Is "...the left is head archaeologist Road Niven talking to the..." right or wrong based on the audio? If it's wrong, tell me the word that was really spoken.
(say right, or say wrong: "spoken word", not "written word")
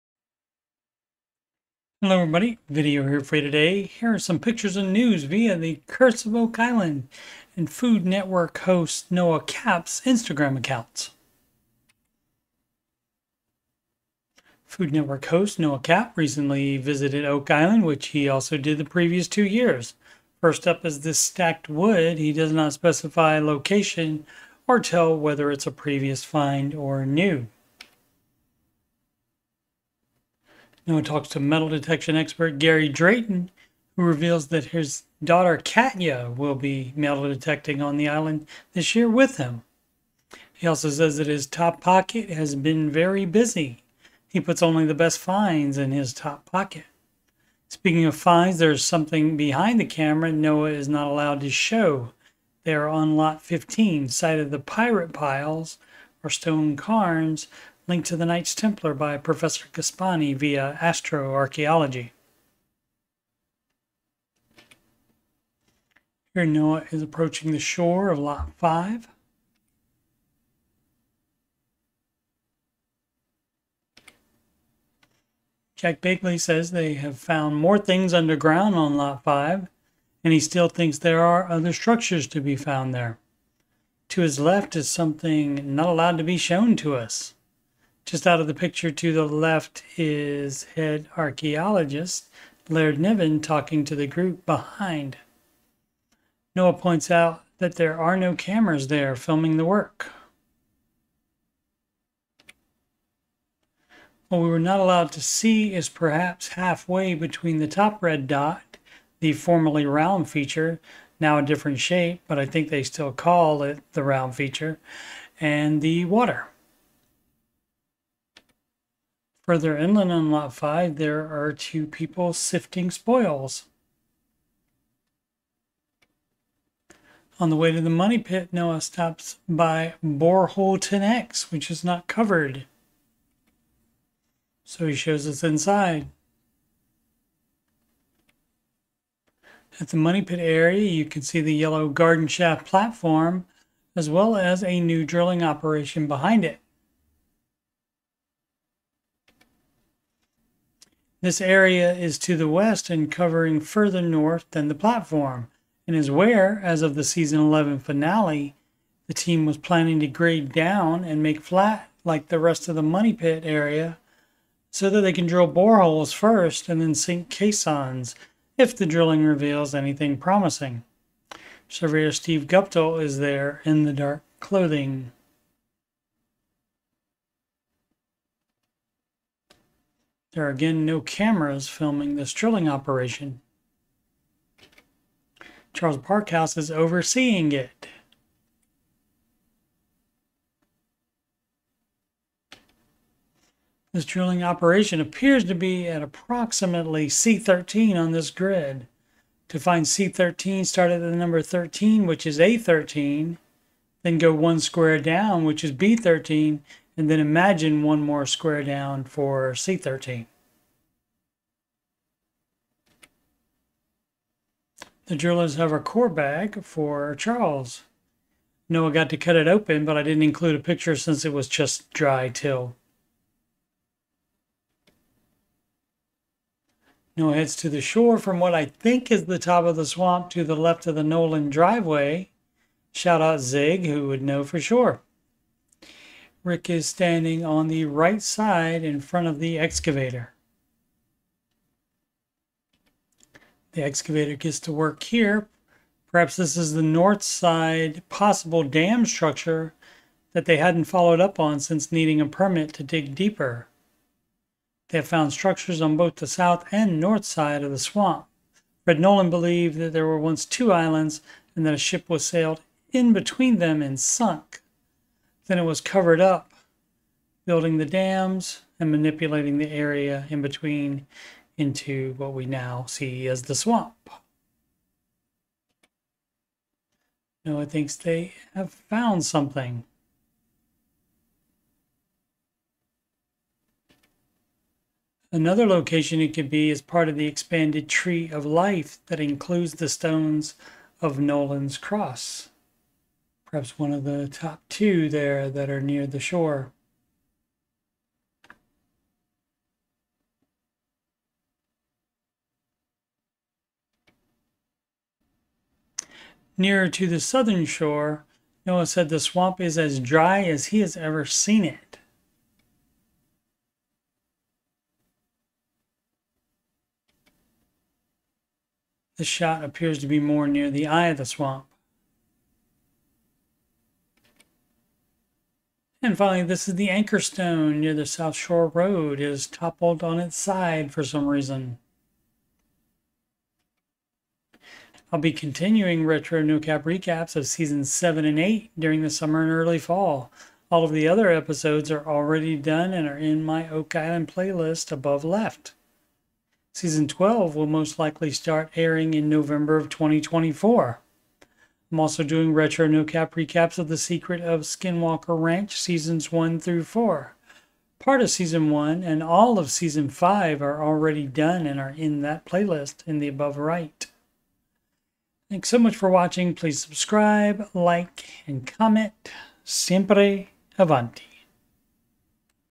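wrong: "Laird", not "Road".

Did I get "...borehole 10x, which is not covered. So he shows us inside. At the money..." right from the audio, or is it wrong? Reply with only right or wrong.
right.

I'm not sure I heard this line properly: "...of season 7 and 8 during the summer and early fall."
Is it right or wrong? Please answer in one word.
right.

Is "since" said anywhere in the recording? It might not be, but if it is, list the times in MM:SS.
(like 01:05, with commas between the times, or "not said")
03:40, 04:11.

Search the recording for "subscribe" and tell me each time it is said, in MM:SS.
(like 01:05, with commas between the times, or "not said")
06:06.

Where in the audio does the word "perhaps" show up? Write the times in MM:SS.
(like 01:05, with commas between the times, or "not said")
01:45, 04:06, 04:53.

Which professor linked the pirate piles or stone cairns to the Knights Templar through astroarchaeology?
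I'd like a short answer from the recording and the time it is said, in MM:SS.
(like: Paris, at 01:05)
Gaspani, at 00:59.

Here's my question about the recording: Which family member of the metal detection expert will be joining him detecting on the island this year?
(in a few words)
Katya.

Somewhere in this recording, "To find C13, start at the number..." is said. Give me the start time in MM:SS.
03:19.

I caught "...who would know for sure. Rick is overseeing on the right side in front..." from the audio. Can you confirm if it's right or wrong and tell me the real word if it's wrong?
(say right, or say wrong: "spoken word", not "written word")
wrong: "standing", not "overseeing".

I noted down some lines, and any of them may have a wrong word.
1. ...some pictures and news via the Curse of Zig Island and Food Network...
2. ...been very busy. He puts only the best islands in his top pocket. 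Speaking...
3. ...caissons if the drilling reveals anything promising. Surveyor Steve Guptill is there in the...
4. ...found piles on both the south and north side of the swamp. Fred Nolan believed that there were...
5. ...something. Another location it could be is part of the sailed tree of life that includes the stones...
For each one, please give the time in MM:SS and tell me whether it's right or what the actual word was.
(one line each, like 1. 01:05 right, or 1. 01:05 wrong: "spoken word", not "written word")
1. 00:04 wrong: "Oak", not "Zig"
2. 00:42 wrong: "finds", not "islands"
3. 02:47 right
4. 04:15 wrong: "structures", not "piles"
5. 04:39 wrong: "expanded", not "sailed".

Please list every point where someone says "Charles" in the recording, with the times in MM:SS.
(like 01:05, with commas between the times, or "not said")
03:05, 03:37.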